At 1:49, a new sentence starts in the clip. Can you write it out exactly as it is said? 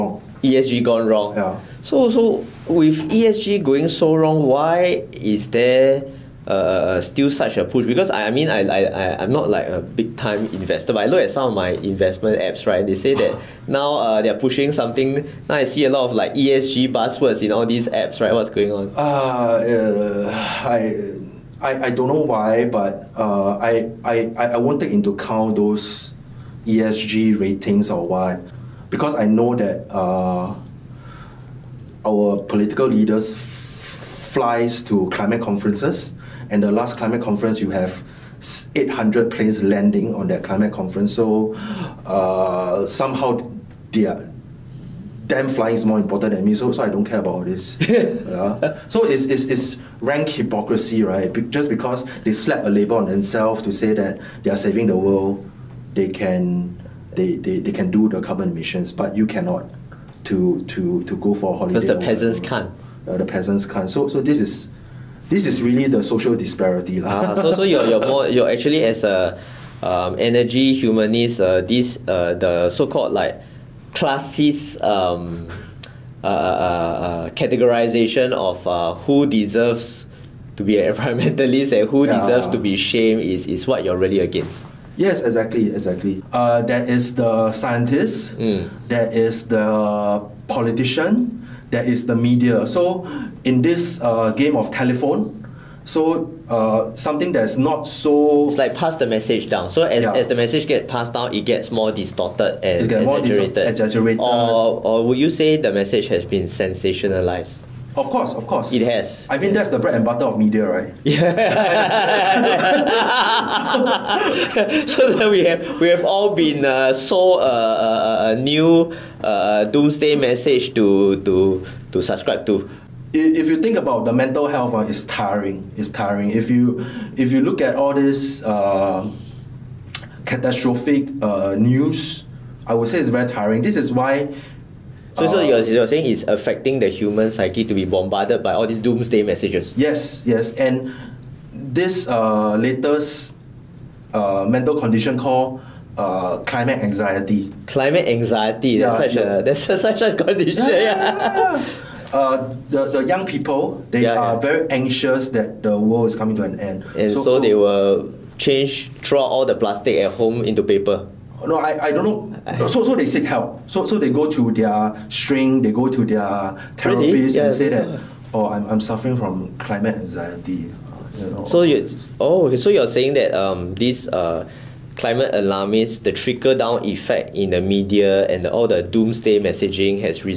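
I mean, that's the bread and butter of media, right?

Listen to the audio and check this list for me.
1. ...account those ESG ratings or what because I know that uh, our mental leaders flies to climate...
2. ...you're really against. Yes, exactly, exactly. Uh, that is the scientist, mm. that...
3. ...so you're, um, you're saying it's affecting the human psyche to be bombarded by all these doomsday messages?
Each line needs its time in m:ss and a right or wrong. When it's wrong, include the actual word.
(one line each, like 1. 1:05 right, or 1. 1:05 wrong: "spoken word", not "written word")
1. 0:25 wrong: "political", not "mental"
2. 1:23 right
3. 2:15 right.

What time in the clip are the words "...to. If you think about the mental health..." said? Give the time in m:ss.
2:02.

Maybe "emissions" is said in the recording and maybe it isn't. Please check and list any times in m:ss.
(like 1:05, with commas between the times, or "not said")
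0:58.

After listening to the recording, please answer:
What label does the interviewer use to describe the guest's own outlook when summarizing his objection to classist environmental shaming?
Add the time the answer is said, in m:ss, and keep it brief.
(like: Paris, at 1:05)
energy humanist, at 1:10.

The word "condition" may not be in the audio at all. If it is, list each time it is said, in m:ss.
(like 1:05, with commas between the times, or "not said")
2:24, 2:30.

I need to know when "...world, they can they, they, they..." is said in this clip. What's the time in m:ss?
0:54.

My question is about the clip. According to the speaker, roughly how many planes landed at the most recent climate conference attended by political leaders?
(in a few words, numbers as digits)
800.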